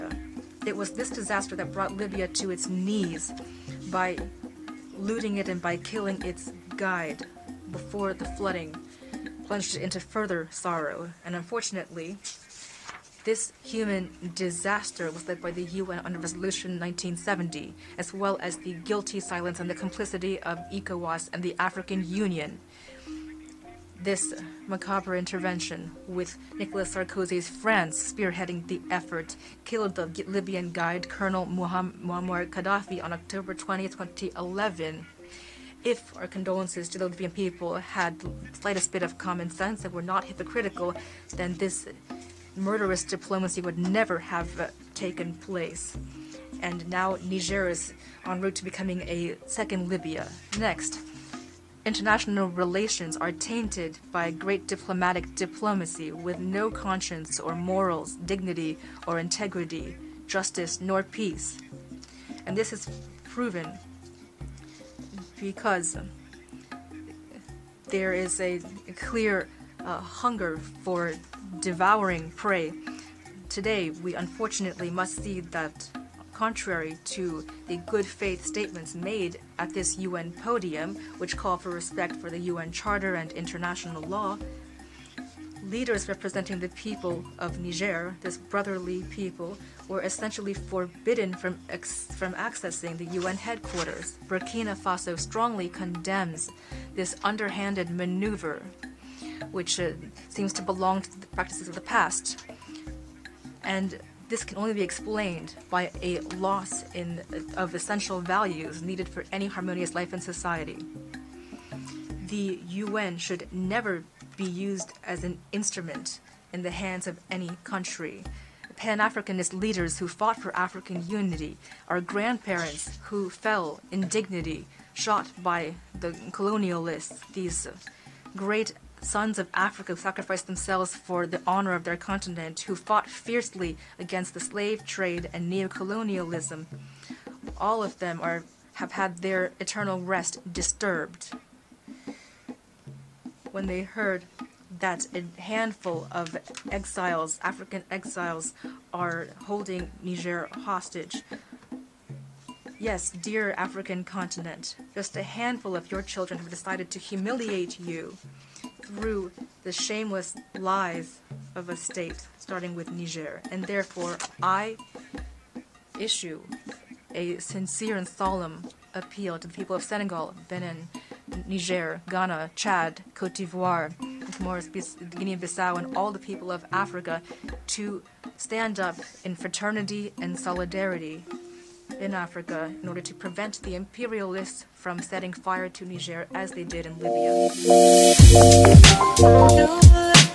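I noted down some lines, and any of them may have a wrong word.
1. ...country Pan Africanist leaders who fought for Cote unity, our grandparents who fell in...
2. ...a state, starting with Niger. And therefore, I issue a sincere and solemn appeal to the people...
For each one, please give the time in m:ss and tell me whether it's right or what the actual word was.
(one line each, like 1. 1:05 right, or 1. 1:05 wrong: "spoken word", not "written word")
1. 1:57 wrong: "African", not "Cote"
2. 2:41 right.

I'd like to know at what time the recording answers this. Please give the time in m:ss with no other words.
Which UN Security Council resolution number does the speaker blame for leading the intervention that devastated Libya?
0:16.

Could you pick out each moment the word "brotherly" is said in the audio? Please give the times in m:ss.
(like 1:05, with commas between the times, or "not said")
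1:28.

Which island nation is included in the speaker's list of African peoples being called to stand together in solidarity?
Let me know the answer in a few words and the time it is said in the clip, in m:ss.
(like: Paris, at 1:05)
Comoros, at 2:54.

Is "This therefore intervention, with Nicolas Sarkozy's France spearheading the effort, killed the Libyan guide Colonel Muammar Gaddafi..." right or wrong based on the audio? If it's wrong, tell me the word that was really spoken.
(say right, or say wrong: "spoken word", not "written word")
wrong: "macabre", not "therefore".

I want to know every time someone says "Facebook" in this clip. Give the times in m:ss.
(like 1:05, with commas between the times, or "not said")
not said.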